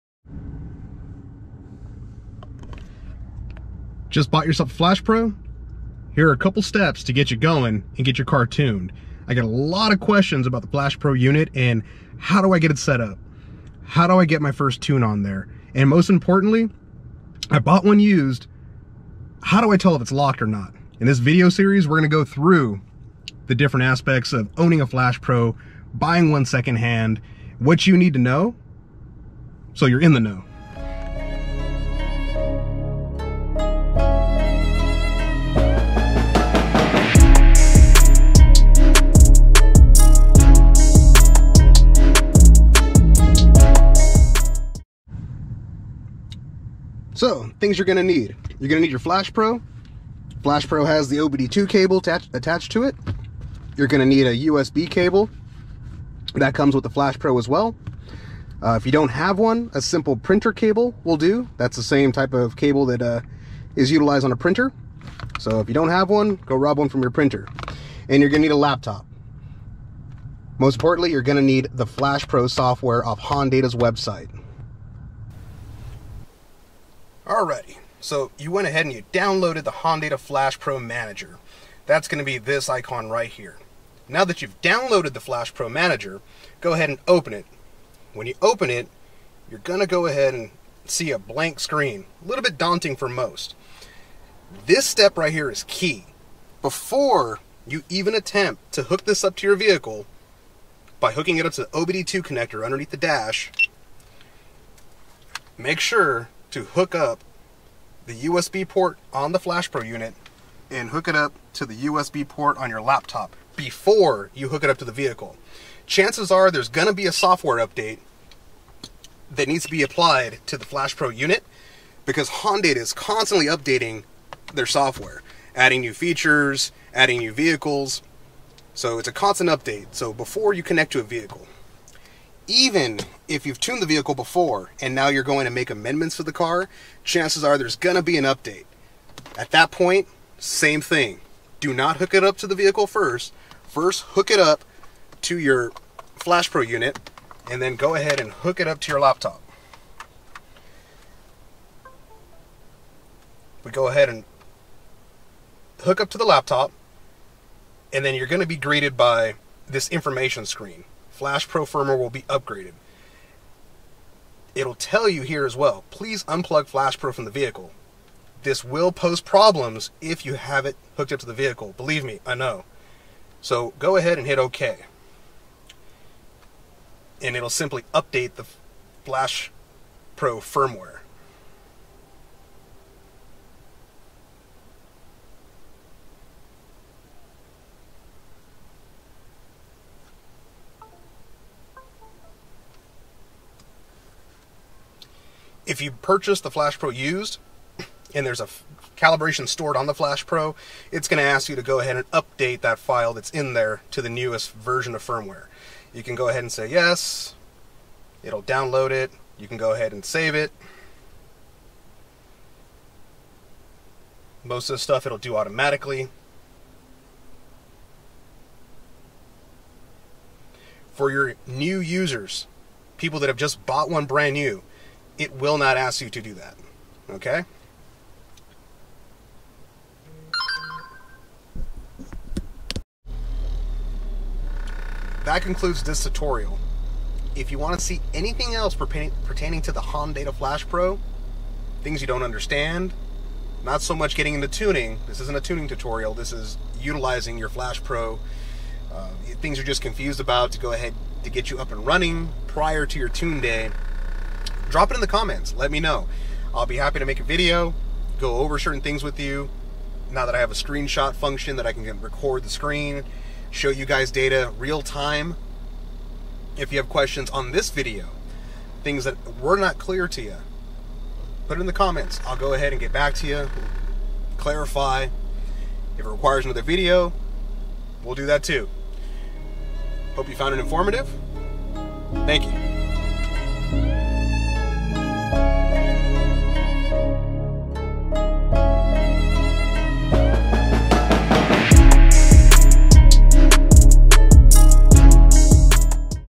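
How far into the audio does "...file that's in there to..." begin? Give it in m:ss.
3:22.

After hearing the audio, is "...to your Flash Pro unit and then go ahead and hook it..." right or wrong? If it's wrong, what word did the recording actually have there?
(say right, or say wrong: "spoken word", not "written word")
right.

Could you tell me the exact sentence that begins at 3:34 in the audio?
Most of the stuff it'll do automatically.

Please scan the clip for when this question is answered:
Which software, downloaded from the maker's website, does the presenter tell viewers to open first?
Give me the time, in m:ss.
1:19.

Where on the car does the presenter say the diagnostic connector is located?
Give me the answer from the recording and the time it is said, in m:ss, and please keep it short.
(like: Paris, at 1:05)
Underneath the dash, at 1:42.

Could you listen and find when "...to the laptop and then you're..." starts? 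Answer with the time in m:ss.
2:36.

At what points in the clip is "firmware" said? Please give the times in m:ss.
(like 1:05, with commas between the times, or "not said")
2:41, 3:00, 3:25.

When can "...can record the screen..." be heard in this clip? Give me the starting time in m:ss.
4:21.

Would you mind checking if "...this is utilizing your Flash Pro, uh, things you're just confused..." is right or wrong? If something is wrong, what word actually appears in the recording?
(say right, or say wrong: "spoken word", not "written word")
right.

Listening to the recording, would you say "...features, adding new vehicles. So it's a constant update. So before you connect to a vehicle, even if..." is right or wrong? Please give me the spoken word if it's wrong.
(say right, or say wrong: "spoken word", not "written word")
right.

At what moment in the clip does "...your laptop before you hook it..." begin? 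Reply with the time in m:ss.
1:52.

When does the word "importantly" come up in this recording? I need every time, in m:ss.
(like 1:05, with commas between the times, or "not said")
0:16, 1:10.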